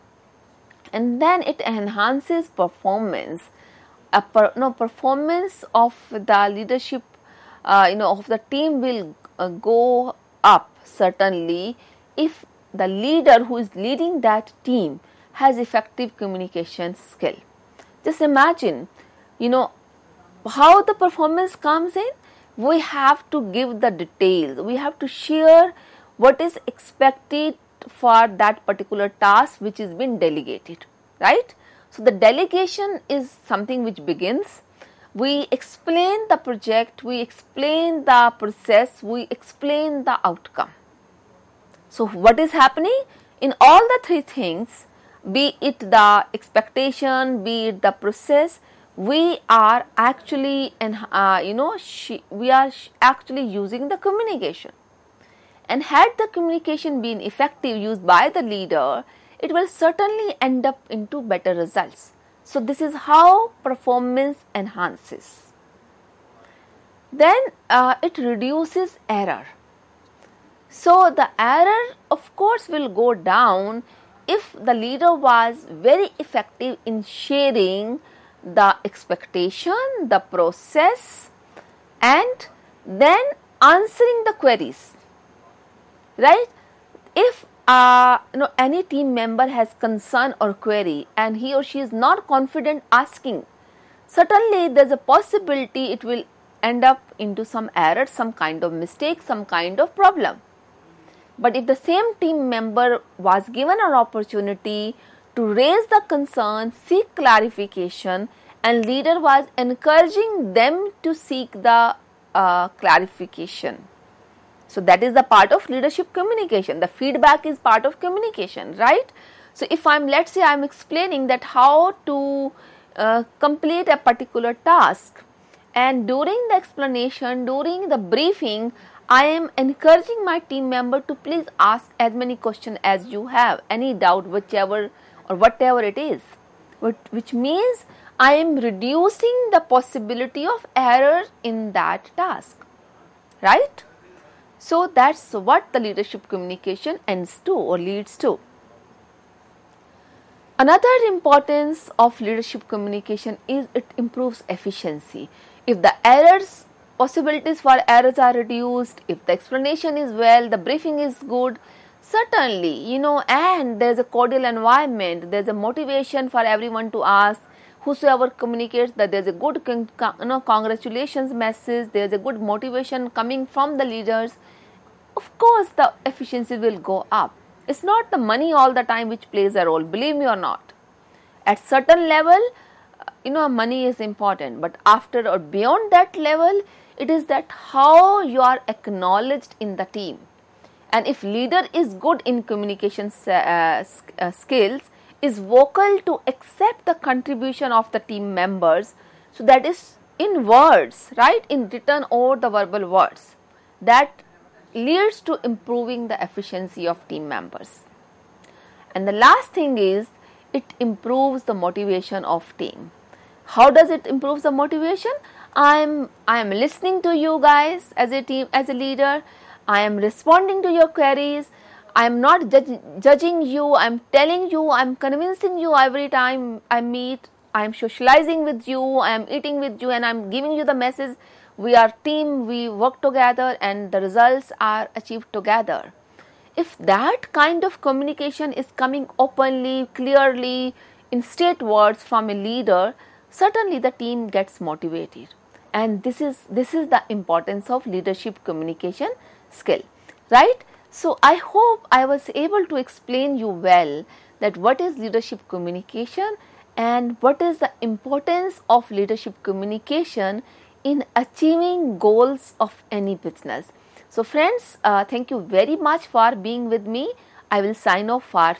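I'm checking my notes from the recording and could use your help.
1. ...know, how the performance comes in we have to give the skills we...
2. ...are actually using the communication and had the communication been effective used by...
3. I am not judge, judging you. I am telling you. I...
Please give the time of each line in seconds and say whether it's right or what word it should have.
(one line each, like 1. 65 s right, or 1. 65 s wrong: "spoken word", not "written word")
1. 19 s wrong: "details", not "skills"
2. 52 s right
3. 221 s right.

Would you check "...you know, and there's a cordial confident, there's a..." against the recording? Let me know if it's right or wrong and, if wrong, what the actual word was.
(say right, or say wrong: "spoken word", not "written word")
wrong: "environment", not "confident".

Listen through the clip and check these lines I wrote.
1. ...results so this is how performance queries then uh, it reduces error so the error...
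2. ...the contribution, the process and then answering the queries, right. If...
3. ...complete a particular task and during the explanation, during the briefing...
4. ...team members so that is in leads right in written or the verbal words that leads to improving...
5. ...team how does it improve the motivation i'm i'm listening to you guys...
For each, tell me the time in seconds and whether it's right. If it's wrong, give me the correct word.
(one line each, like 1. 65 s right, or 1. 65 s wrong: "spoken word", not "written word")
1. 61 s wrong: "enhances", not "queries"
2. 78 s wrong: "expectation", not "contribution"
3. 123 s right
4. 198 s wrong: "words", not "leads"
5. 212 s right.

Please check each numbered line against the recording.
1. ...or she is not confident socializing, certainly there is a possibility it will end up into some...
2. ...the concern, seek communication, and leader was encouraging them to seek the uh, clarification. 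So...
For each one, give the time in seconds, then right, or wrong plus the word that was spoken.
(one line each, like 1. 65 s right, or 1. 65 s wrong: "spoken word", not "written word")
1. 91 s wrong: "asking", not "socializing"
2. 105 s wrong: "clarification", not "communication".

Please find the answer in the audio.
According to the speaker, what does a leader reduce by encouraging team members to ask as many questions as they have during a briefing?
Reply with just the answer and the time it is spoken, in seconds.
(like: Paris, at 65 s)
possibility of error, at 138 s.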